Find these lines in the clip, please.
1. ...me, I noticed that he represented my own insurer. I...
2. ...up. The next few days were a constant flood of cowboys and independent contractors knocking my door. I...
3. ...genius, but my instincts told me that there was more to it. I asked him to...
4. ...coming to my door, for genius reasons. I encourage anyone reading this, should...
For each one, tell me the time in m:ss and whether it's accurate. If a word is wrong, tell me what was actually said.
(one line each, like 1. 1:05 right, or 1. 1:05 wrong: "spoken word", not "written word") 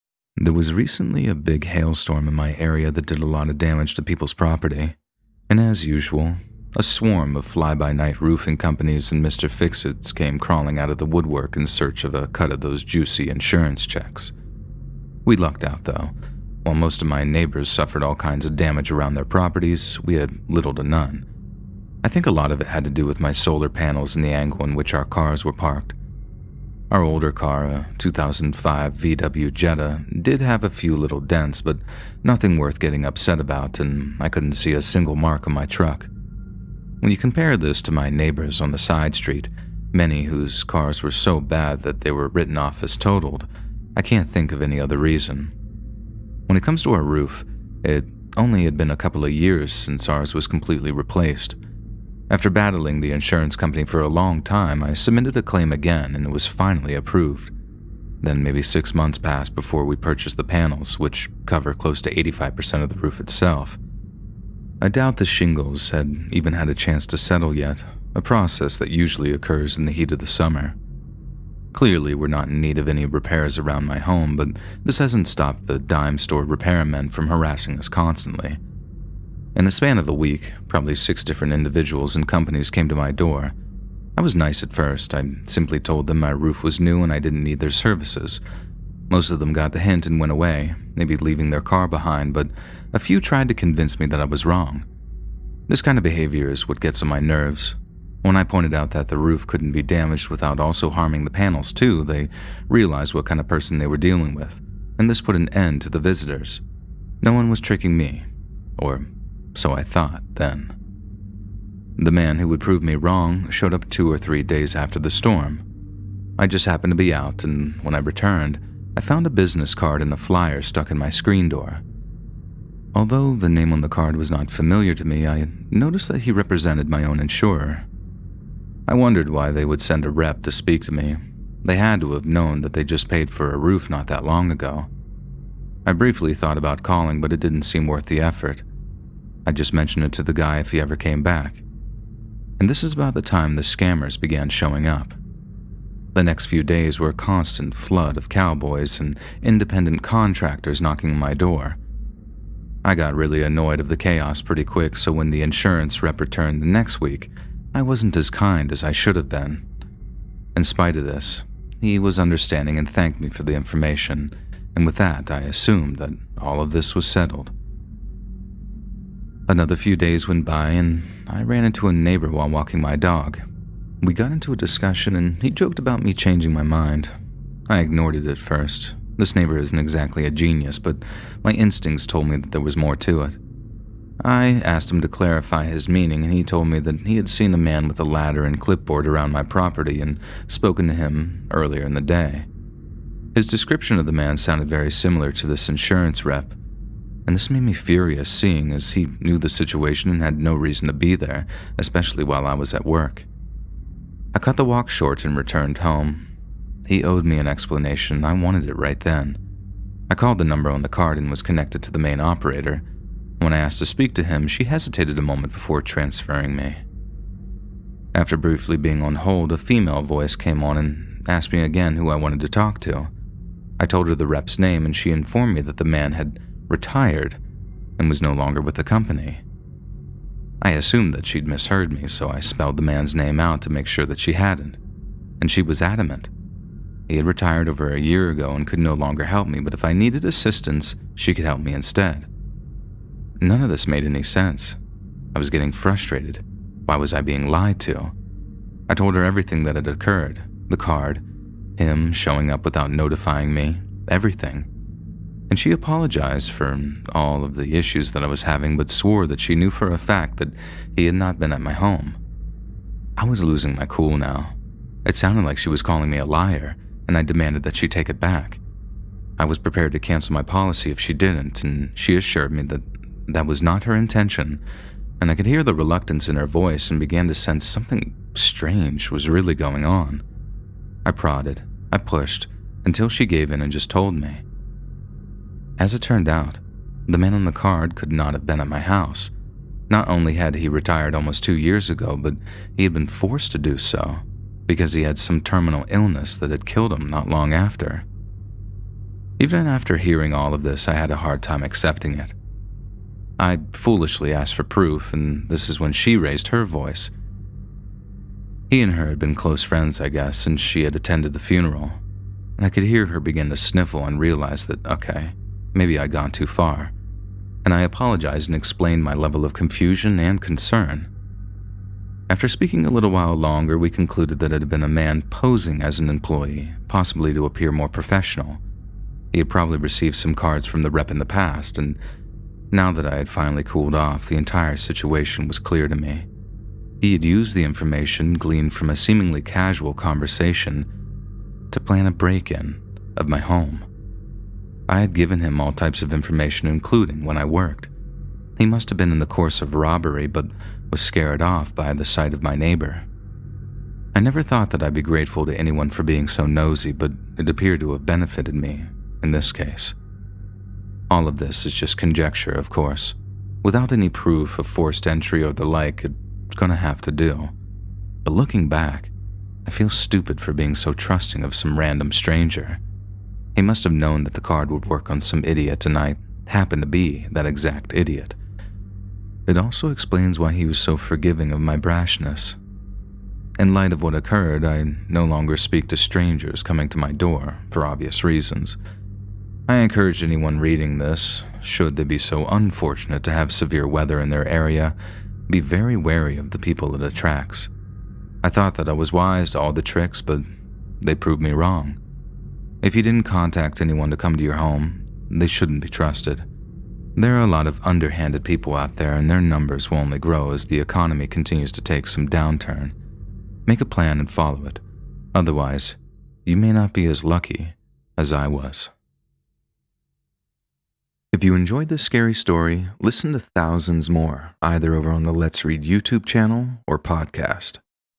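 1. 2:05 right
2. 2:24 right
3. 3:00 right
4. 6:26 wrong: "obvious", not "genius".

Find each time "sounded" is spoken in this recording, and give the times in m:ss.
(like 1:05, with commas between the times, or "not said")
3:14, 4:25.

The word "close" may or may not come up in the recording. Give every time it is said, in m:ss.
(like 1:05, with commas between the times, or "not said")
1:01, 5:09.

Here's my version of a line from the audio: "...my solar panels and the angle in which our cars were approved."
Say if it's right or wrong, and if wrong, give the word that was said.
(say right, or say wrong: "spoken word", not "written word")
wrong: "parked", not "approved".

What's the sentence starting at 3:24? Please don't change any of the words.
I cut the walk short and returned home.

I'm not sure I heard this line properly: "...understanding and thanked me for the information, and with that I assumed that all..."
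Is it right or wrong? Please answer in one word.
right.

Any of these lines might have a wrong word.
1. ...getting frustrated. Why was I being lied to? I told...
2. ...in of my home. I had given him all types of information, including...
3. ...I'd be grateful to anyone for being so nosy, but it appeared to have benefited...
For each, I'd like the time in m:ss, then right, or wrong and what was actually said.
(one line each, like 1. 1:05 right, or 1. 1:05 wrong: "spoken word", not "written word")
1. 4:05 right
2. 5:42 right
3. 5:54 right.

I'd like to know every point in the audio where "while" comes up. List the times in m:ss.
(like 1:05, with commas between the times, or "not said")
0:16, 2:52, 3:22, 5:23.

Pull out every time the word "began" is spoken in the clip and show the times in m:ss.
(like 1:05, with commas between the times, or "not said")
2:24, 4:36.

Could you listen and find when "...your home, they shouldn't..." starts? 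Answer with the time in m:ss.
6:44.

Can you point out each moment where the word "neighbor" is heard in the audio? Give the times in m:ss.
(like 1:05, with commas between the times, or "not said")
0:17, 0:38, 2:51, 2:59, 5:52.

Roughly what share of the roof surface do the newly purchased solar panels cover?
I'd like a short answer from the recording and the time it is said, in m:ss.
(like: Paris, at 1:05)
85%, at 1:02.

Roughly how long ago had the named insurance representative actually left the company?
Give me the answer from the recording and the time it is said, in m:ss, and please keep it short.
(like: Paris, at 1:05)
Almost 2 years, at 4:51.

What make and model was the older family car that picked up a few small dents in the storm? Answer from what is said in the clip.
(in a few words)
VW Jetta.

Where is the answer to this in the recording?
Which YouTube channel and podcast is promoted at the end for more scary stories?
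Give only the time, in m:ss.
7:05.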